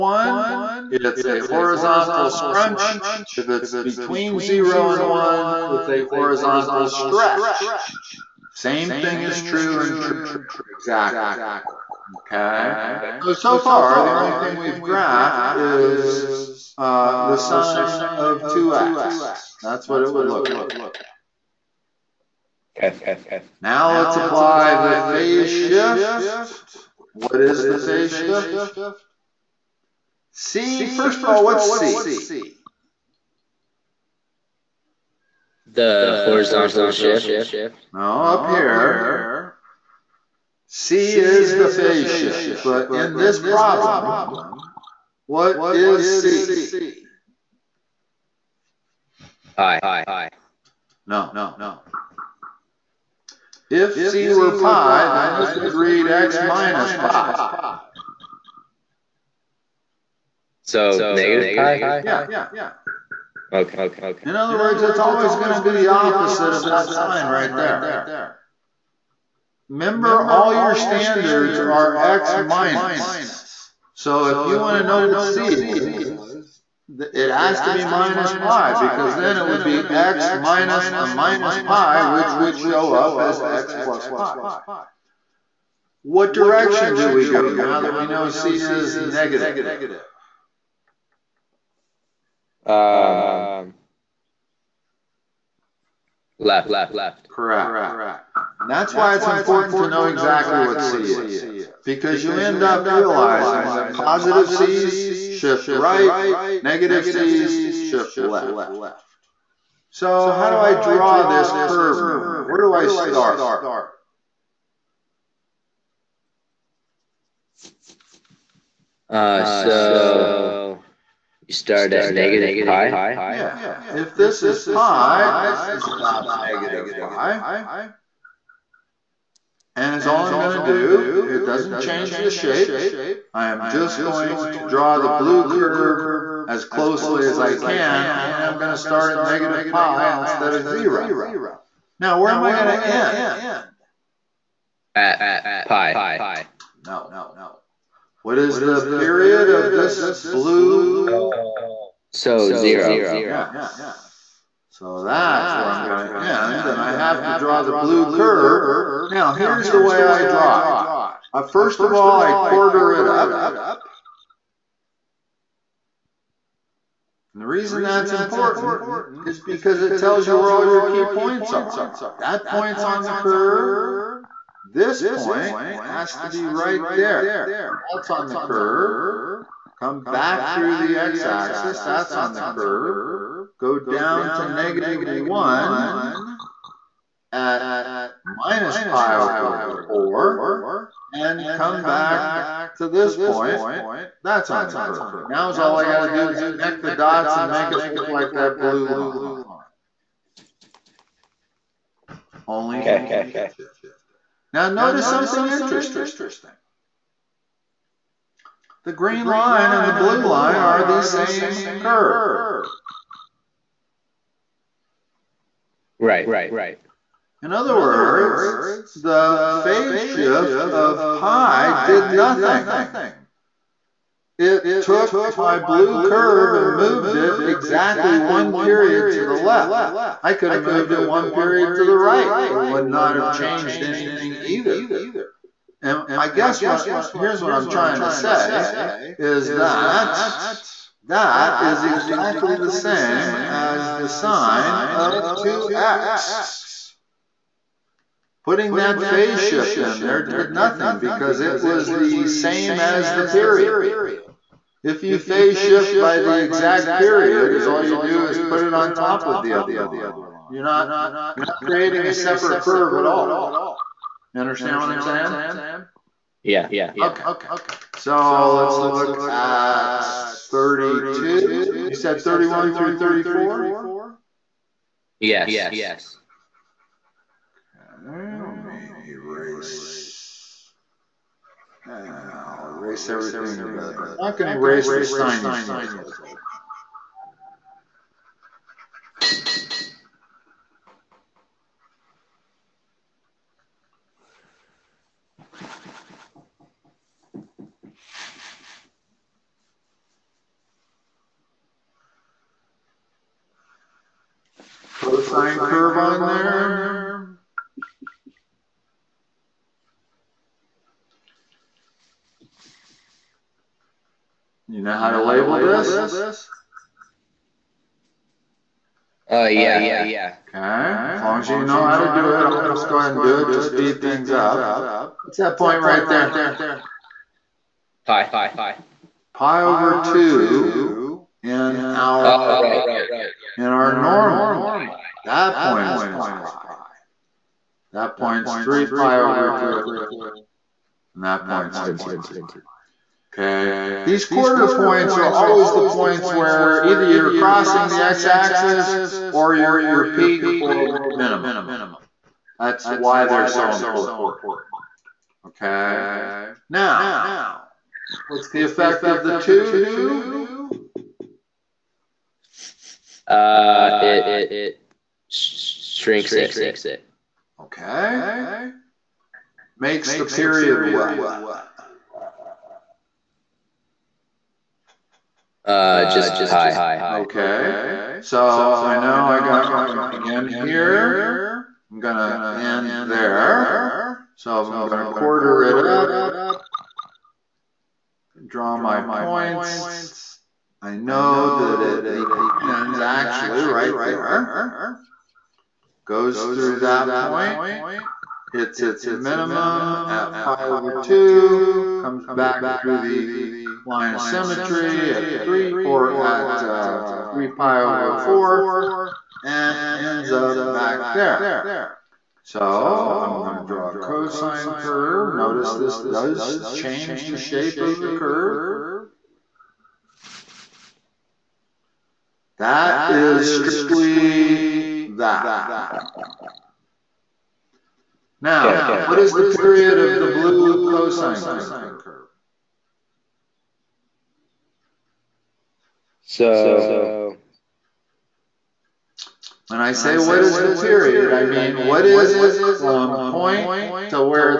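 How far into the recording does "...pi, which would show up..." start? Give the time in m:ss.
1:21.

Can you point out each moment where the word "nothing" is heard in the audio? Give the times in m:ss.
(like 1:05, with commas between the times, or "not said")
3:42, 4:10.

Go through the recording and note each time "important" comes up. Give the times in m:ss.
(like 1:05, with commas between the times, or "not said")
1:39, 2:48, 5:53.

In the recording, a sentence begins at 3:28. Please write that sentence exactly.
The green line and the blue line are the same curve.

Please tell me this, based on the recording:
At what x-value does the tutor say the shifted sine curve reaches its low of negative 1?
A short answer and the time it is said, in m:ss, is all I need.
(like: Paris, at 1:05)
minus pi over 4, at 3:08.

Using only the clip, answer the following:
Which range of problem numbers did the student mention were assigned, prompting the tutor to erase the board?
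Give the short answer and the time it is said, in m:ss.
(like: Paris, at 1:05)
31 through 34, at 4:32.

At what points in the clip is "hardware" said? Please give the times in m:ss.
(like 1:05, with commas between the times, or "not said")
not said.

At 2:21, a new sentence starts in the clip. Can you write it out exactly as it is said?
Now, where am I going to end?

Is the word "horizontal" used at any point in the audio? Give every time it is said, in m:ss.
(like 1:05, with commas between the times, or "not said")
0:01, 0:06, 0:36.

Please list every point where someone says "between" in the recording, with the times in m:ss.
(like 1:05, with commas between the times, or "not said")
0:03.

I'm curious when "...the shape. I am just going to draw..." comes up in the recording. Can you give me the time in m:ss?
2:12.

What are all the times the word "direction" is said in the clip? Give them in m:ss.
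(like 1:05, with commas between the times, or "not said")
1:26.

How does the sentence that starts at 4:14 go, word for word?
If you phase shift by the exact period, is all you do is put it on top of the other line.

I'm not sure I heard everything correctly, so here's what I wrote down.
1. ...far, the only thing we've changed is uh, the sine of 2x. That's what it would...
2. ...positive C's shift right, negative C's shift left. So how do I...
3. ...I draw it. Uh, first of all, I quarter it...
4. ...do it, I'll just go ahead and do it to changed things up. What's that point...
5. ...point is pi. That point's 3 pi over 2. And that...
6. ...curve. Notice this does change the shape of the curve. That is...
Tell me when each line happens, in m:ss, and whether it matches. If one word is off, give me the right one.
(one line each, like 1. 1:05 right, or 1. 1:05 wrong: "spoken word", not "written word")
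1. 0:13 wrong: "graphed", not "changed"
2. 1:43 right
3. 2:40 right
4. 5:22 wrong: "speed", not "changed"
5. 5:35 right
6. 6:54 right.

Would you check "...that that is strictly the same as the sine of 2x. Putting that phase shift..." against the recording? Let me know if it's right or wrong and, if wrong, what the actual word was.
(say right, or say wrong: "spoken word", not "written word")
wrong: "exactly", not "strictly".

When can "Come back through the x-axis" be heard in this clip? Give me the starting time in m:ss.
2:59.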